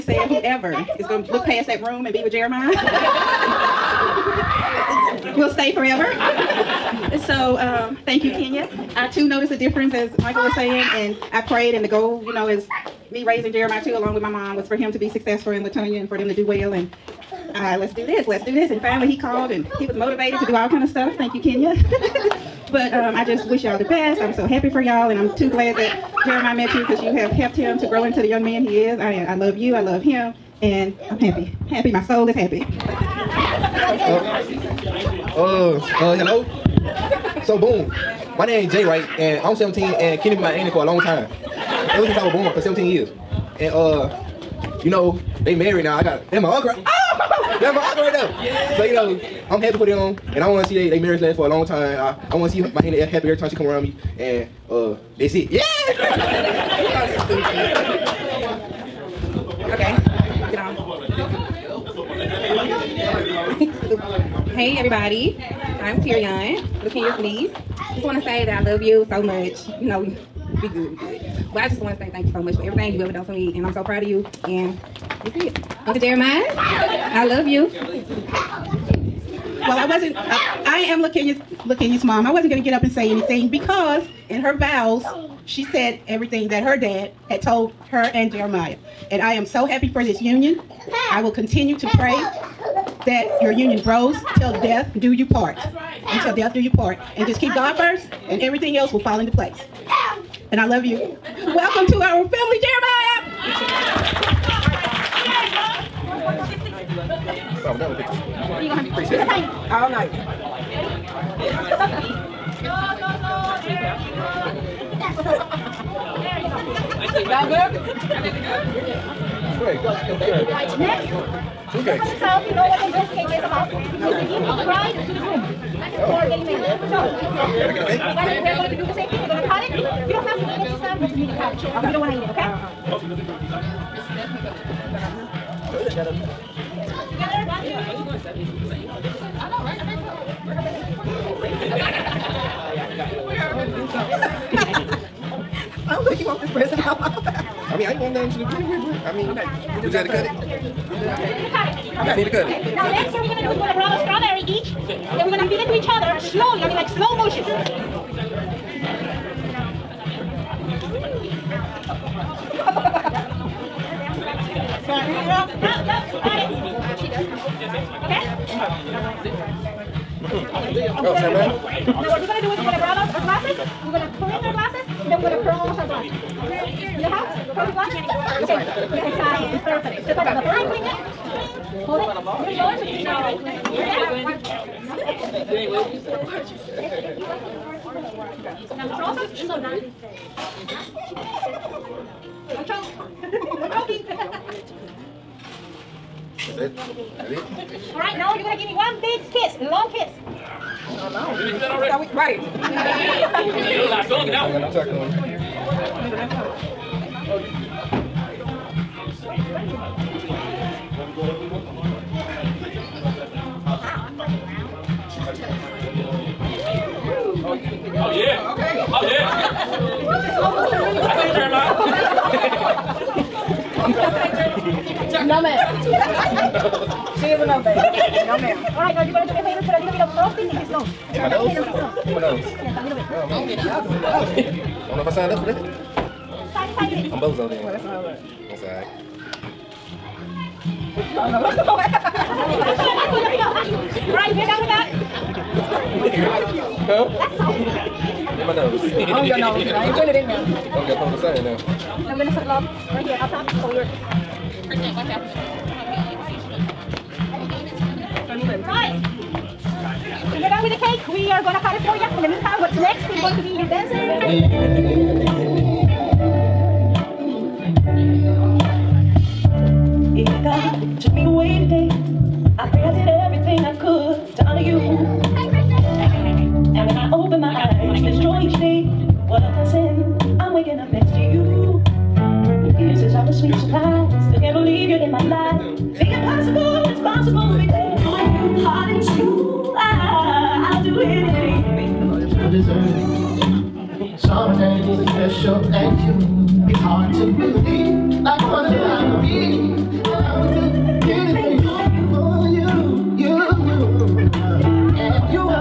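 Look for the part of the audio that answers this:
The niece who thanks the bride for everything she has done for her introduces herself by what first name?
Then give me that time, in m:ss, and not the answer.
1:06.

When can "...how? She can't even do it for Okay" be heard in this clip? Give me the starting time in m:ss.
2:57.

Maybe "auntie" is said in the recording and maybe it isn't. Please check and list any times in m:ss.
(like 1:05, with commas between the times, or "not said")
0:40, 0:52.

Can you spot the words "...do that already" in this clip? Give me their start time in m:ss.
3:21.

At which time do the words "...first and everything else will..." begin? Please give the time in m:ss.
1:37.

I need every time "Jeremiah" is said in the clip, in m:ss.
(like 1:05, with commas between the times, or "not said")
0:02, 0:13, 0:26, 1:15, 1:28, 1:43.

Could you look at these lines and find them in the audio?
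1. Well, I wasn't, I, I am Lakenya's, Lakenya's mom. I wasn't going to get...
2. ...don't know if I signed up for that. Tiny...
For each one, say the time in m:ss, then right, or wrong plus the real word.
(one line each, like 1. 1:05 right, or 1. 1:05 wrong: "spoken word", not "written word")
1. 1:19 right
2. 3:54 right.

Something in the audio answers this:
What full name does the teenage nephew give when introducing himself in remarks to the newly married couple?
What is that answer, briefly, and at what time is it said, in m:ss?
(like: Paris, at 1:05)
Jay Wright, at 0:38.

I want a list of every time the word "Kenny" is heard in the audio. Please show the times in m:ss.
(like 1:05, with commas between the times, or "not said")
0:40.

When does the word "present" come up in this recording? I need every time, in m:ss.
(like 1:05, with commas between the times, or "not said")
2:26.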